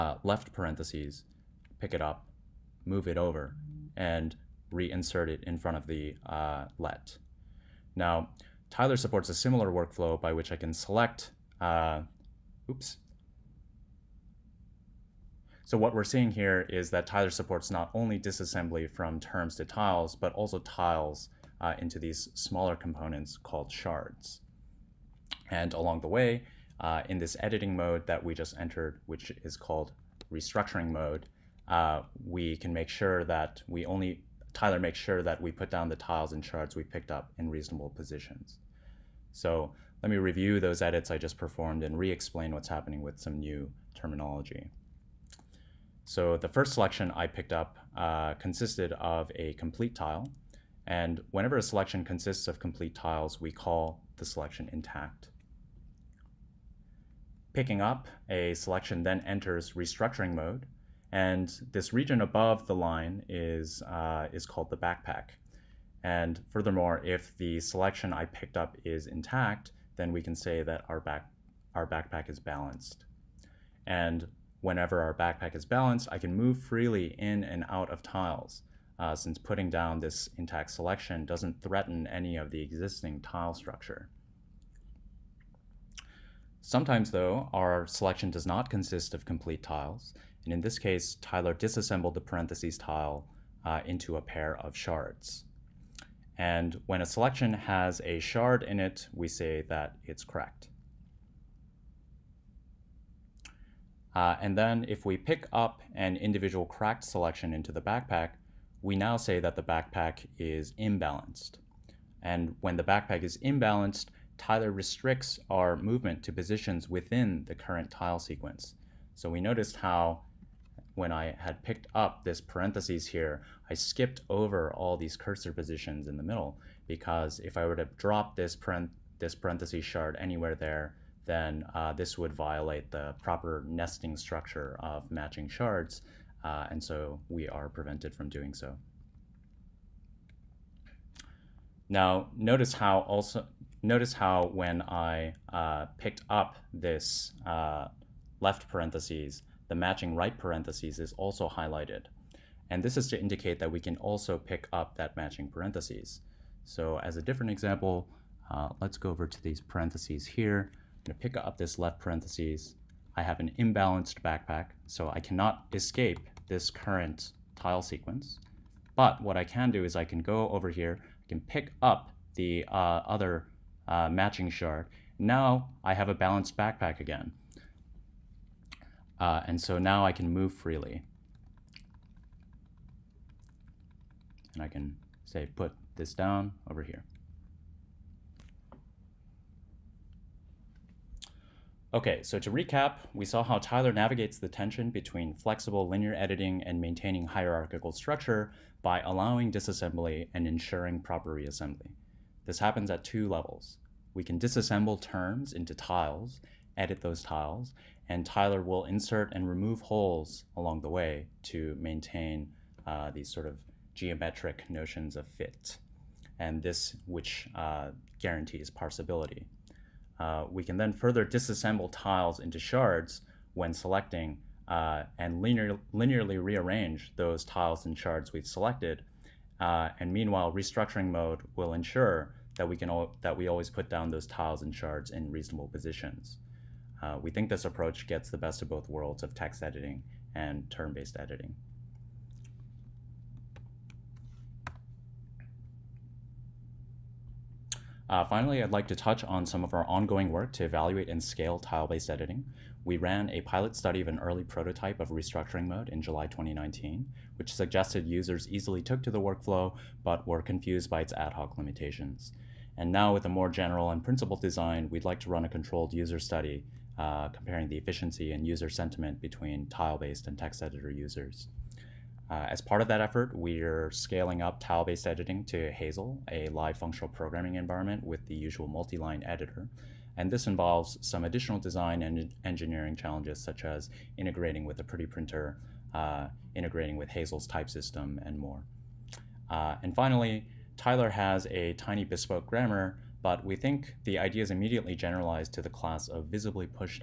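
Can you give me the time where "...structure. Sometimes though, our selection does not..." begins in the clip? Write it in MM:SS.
01:23.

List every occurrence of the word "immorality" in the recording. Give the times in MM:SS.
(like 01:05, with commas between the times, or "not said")
not said.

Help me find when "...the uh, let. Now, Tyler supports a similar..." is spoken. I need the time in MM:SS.
00:05.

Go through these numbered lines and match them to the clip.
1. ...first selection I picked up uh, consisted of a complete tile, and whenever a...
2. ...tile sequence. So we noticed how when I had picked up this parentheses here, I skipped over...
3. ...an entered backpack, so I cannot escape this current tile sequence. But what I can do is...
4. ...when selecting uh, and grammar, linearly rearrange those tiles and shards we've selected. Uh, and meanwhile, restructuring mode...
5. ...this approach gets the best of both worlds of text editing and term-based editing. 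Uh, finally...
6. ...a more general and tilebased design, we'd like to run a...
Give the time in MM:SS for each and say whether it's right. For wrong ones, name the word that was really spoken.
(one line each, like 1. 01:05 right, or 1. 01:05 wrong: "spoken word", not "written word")
1. 00:46 right
2. 01:57 right
3. 02:43 wrong: "imbalanced", not "entered"
4. 03:43 wrong: "linear", not "grammar"
5. 03:57 right
6. 04:23 wrong: "principled", not "tilebased".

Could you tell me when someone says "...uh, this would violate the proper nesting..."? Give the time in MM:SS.
02:11.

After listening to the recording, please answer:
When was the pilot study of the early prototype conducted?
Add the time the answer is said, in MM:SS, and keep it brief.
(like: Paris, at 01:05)
July 2019, at 04:16.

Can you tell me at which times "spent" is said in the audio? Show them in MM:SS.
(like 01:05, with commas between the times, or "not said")
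not said.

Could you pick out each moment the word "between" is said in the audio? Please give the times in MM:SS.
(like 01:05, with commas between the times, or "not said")
03:14, 04:29.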